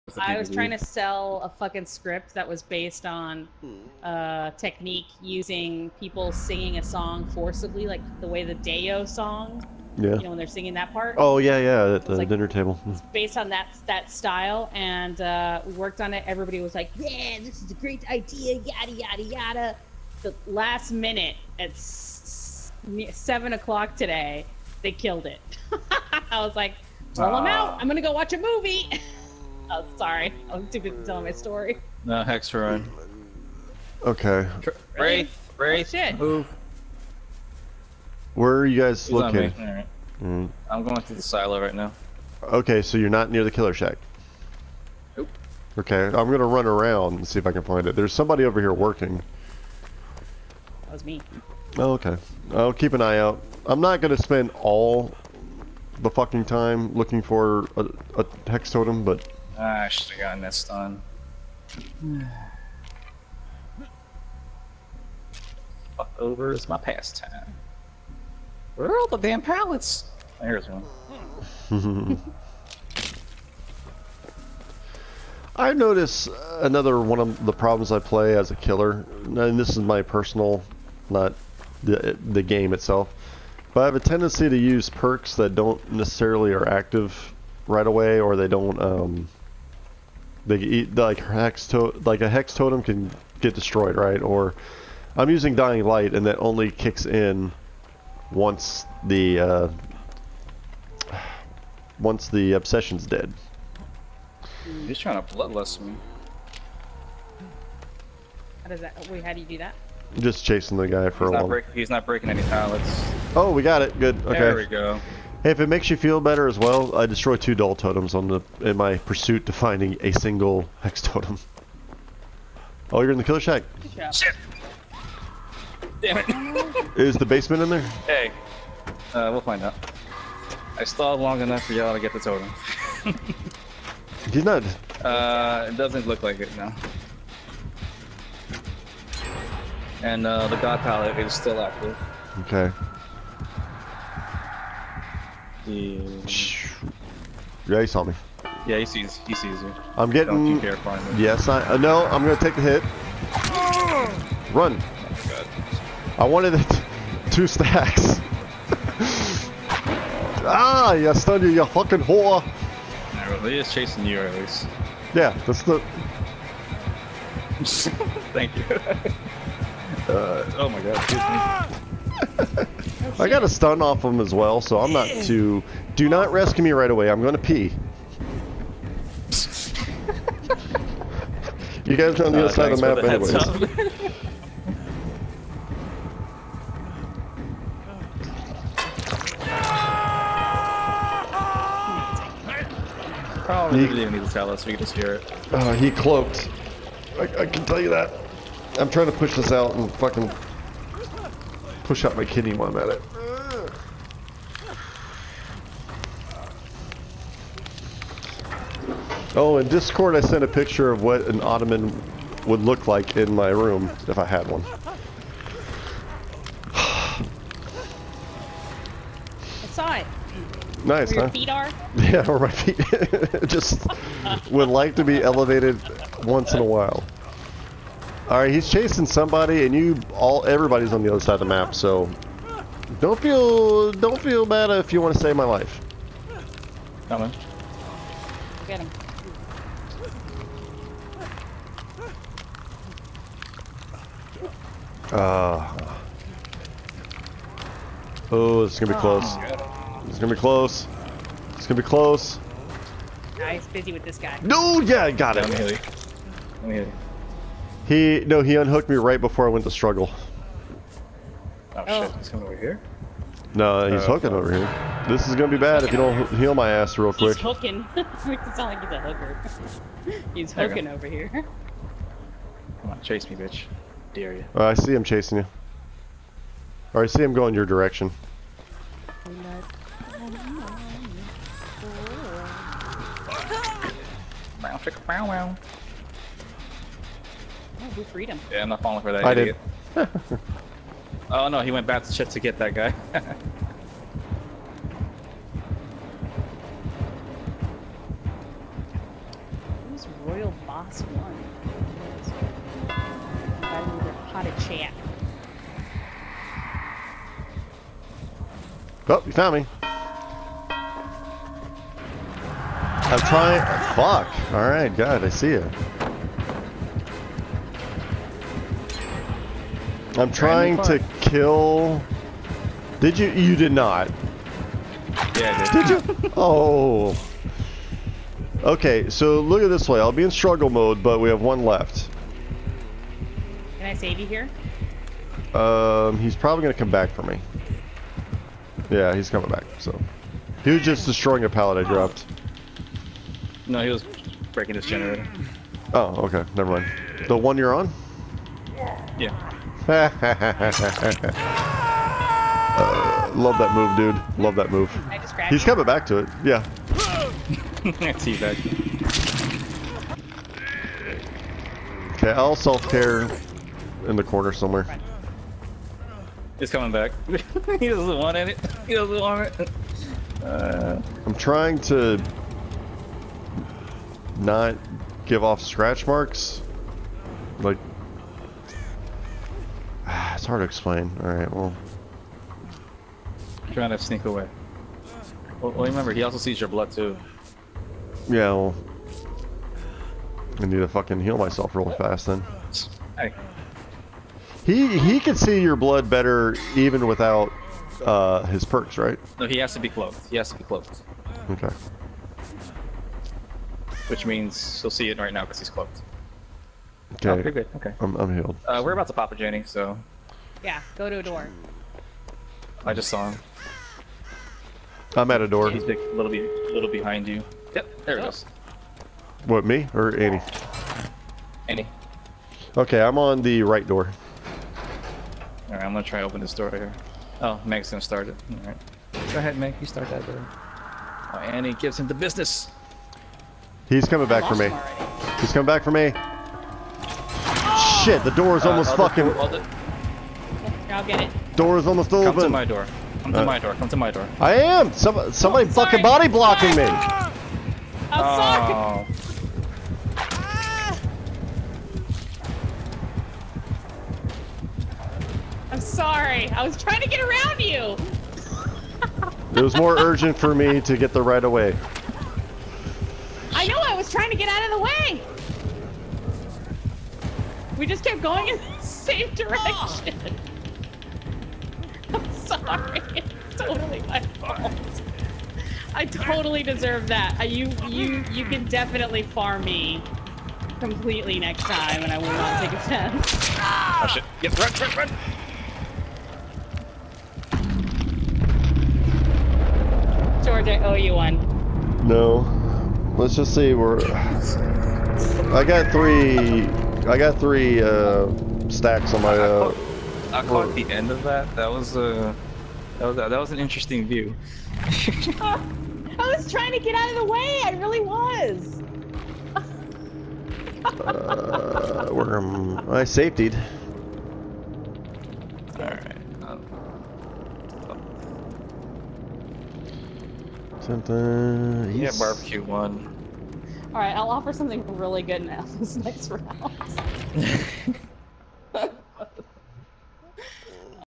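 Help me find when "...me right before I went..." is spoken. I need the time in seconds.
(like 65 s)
258 s.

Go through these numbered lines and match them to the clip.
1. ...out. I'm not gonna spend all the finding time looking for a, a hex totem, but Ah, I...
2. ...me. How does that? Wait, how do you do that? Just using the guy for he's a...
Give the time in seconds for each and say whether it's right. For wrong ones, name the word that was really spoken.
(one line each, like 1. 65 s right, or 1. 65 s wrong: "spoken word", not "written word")
1. 53 s wrong: "fucking", not "finding"
2. 105 s wrong: "chasing", not "using".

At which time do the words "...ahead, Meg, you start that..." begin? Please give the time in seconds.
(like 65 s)
429 s.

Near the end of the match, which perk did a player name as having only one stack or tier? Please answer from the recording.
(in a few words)
Barbecue.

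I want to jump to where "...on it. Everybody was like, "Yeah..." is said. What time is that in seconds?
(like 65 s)
15 s.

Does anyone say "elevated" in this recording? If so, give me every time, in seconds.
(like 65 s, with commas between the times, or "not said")
225 s.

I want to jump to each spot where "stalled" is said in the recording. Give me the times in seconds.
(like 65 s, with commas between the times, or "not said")
130 s.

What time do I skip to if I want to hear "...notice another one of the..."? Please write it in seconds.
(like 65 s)
75 s.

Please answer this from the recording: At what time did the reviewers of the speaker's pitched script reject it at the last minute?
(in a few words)
7 o'clock.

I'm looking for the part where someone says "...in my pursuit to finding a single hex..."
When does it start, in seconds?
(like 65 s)
118 s.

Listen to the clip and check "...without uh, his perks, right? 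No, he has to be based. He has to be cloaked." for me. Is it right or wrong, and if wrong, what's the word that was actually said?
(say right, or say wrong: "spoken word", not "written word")
wrong: "cloaked", not "based".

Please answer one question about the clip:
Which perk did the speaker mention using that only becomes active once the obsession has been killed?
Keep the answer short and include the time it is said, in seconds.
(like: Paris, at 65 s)
Dying Light, at 95 s.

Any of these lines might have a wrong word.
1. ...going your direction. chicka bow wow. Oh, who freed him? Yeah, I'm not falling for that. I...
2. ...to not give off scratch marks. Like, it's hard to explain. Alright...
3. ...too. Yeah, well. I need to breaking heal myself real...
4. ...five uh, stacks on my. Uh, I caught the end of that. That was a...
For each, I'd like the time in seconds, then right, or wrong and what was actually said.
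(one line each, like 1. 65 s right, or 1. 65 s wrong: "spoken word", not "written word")
1. 277 s right
2. 371 s right
3. 386 s wrong: "fucking", not "breaking"
4. 497 s wrong: "three", not "five".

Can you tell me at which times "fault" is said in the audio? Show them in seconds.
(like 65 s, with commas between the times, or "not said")
474 s.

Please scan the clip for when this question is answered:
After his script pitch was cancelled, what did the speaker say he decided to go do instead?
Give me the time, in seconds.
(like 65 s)
28 s.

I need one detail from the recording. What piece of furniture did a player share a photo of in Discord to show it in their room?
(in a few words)
Ottoman.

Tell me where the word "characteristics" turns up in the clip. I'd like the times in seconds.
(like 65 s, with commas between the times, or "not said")
not said.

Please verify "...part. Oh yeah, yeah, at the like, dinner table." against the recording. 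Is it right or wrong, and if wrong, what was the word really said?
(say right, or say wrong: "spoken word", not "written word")
right.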